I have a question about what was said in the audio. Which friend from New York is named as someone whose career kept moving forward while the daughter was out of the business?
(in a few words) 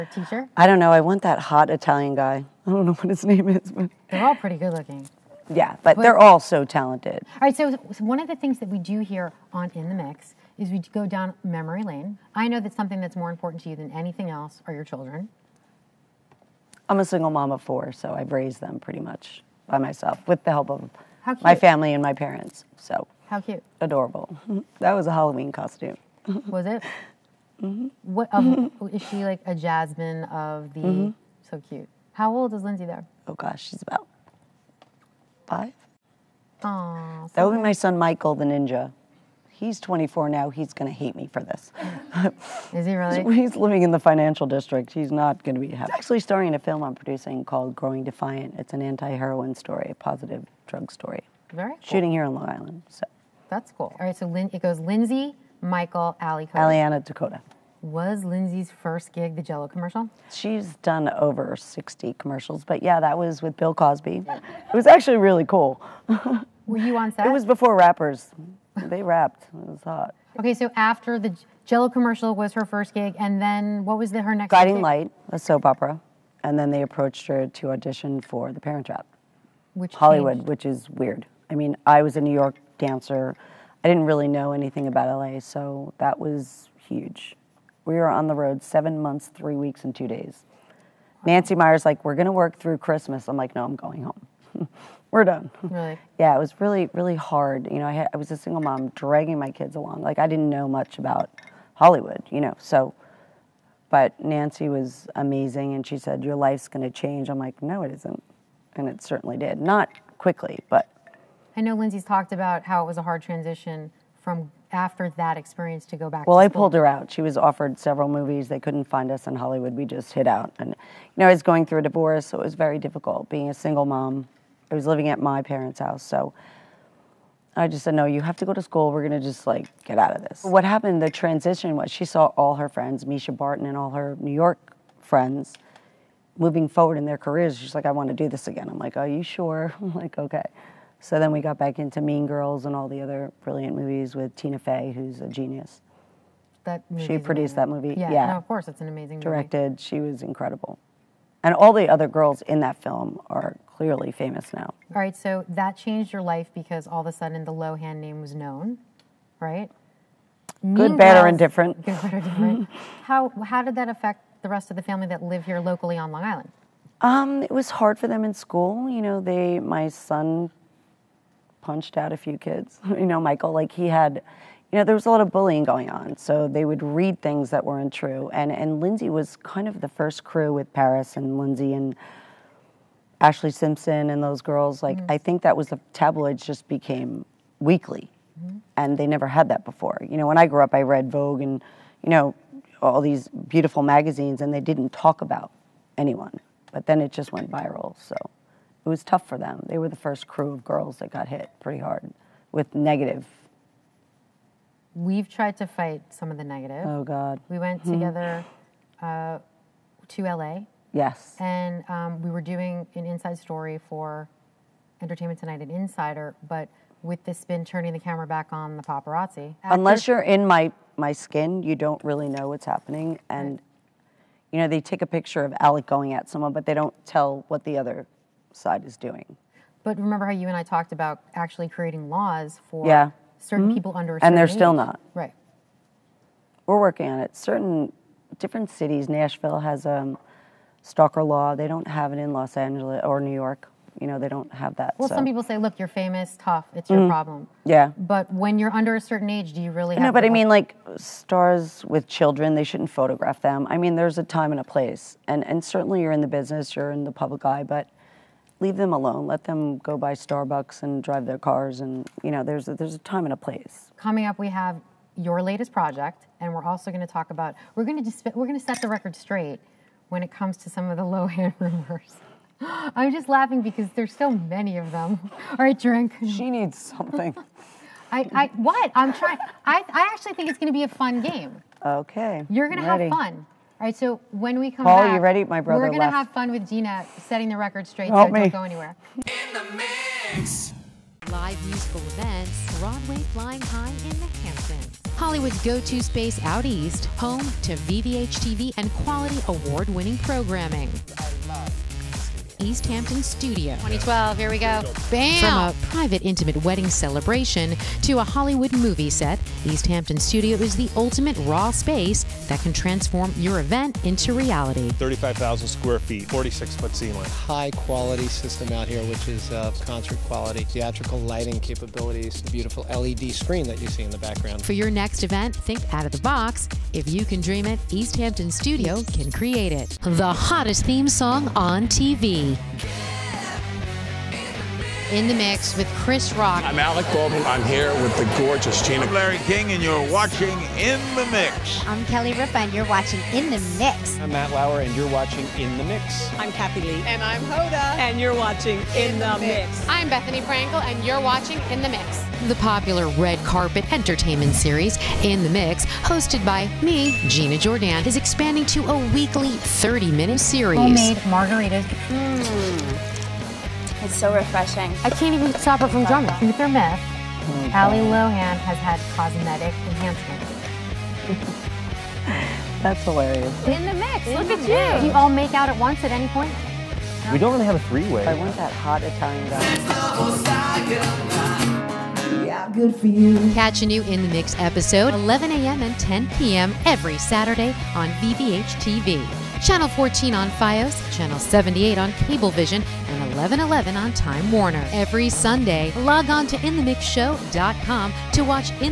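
Mischa Barton.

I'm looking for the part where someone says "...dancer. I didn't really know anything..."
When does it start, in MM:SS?
01:22.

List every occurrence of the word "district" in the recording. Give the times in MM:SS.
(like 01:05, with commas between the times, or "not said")
00:44.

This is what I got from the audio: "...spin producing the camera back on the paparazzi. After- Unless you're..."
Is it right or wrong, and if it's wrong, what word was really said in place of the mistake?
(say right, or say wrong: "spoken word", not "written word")
wrong: "turning", not "producing".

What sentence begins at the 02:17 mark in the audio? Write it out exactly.
She's like, I want to do this again.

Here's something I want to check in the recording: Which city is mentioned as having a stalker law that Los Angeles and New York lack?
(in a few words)
Nashville.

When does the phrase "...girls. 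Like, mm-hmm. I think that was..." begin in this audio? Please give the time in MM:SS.
03:04.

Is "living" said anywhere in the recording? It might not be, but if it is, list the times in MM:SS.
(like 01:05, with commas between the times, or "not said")
00:43, 02:04.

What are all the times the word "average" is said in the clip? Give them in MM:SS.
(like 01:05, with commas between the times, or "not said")
not said.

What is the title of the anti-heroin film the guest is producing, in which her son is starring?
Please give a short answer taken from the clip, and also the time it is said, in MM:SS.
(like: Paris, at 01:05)
Growing Defiant, at 00:47.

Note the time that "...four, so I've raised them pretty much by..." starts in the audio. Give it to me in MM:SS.
00:17.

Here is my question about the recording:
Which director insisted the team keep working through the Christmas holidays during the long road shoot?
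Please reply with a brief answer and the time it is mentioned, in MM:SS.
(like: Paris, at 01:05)
Nancy Meyers, at 01:31.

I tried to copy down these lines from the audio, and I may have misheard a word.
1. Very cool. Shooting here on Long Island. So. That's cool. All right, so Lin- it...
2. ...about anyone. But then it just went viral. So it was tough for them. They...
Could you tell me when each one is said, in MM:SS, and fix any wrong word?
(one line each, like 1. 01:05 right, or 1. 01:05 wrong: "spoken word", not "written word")
1. 00:51 right
2. 03:15 right.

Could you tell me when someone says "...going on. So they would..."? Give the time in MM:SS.
02:55.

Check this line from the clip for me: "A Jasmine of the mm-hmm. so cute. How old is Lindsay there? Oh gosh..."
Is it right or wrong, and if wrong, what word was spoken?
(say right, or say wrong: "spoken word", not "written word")
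right.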